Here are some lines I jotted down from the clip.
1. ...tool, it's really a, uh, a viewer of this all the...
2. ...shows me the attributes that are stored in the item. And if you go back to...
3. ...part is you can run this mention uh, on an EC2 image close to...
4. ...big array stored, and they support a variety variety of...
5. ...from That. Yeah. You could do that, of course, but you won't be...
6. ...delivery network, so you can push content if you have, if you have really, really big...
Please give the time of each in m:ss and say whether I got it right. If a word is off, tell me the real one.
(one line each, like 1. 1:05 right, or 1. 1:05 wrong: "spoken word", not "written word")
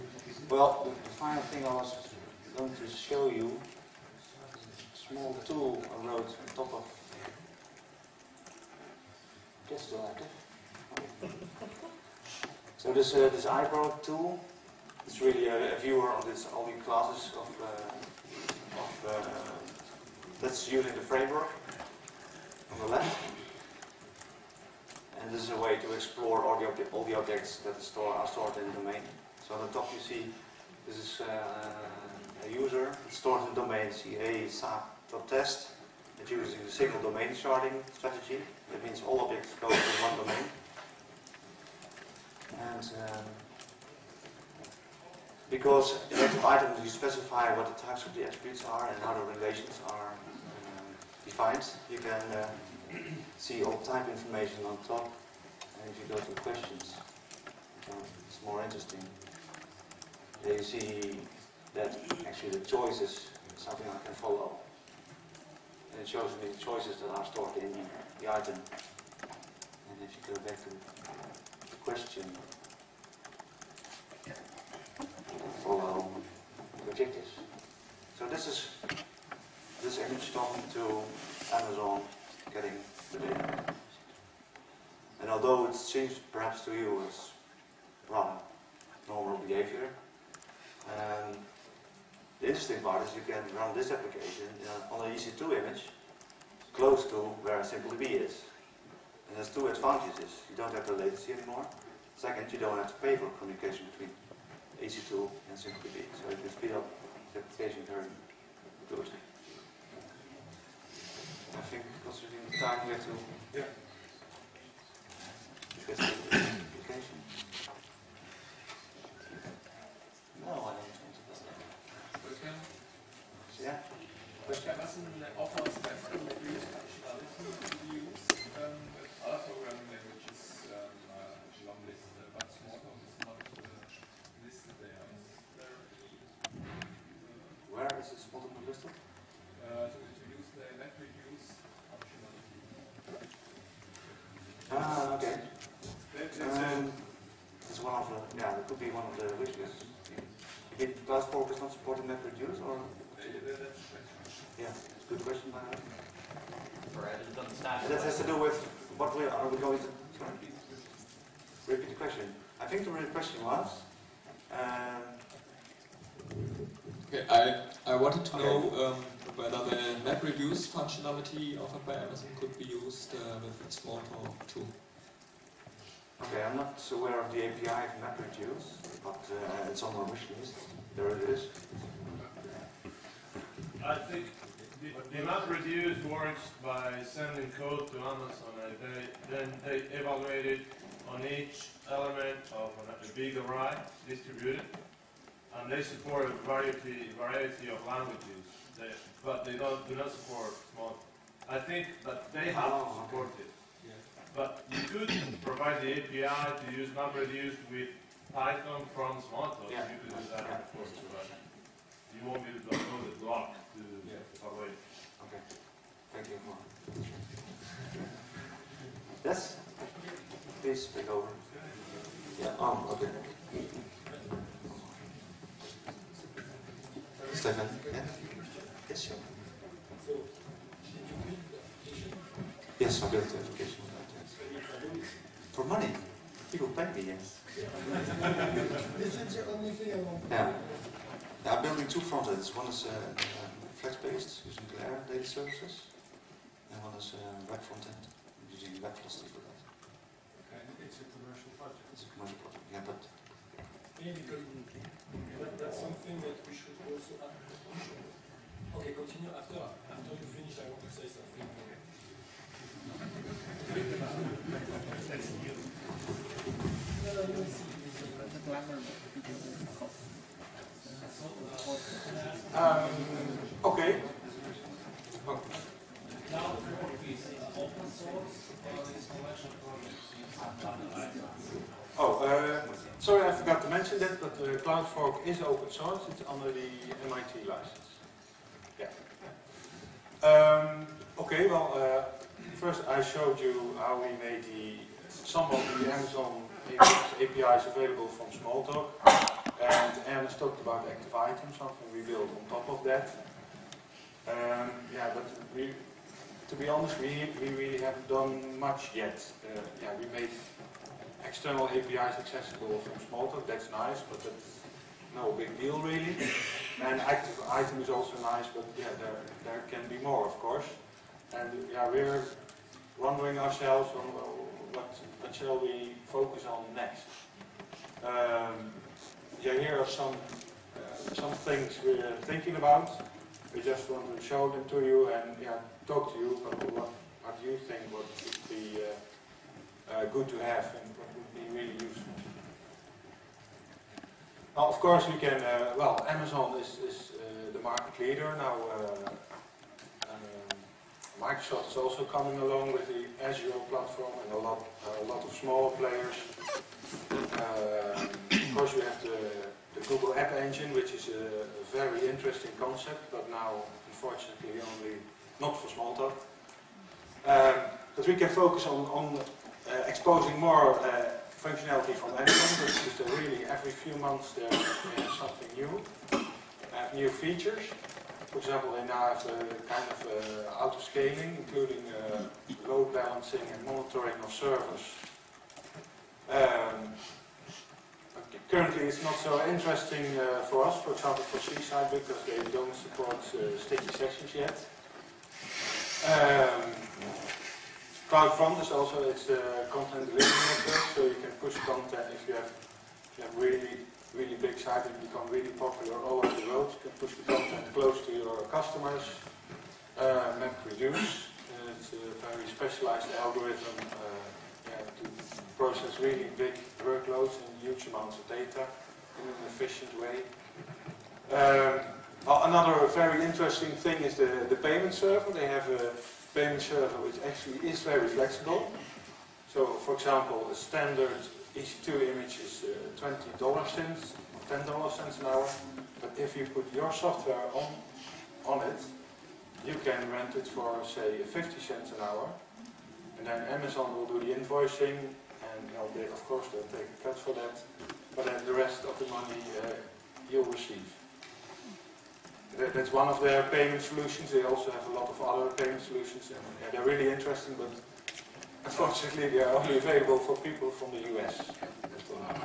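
1. 0:14 right
2. 1:06 wrong: "choices", not "attributes"
3. 1:32 wrong: "application", not "mention"
4. 3:13 wrong: "distributed", not "stored"
5. 3:28 wrong: "Smalltalk", not "That"
6. 6:40 right.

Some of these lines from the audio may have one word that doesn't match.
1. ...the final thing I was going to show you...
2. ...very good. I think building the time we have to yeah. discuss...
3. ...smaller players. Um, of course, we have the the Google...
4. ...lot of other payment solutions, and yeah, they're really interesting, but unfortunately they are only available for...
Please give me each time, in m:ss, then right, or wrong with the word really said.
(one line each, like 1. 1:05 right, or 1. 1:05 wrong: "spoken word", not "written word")
1. 0:01 right
2. 1:47 wrong: "considering", not "building"
3. 5:55 right
4. 7:34 right.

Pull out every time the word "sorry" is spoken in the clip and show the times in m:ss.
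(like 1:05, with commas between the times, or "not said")
2:40, 4:42.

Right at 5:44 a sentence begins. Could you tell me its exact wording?
Now, of course, we can, uh, well, Amazon is, is uh, the market leader.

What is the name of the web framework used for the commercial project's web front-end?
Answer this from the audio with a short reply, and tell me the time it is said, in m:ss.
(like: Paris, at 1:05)
WebFlossD, at 4:08.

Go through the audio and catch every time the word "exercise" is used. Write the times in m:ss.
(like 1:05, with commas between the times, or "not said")
not said.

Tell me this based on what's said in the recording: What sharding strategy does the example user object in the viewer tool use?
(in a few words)
single domain sharding strategy.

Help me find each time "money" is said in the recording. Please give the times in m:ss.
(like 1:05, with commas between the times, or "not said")
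3:55, 7:29.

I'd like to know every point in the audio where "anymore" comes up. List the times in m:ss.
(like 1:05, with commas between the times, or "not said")
1:41.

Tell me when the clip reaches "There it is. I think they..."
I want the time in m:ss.
3:00.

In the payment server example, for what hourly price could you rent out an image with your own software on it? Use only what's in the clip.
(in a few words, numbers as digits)
50 cents.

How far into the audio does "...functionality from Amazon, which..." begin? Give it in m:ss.
6:11.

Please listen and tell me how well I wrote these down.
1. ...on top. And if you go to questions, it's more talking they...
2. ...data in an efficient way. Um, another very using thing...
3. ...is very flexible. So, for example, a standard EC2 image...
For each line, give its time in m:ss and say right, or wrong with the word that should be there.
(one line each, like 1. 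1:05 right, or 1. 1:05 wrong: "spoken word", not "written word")
1. 0:54 wrong: "interesting", not "talking"
2. 6:58 wrong: "interesting", not "using"
3. 7:07 right.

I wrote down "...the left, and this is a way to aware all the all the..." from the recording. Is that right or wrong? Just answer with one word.
wrong.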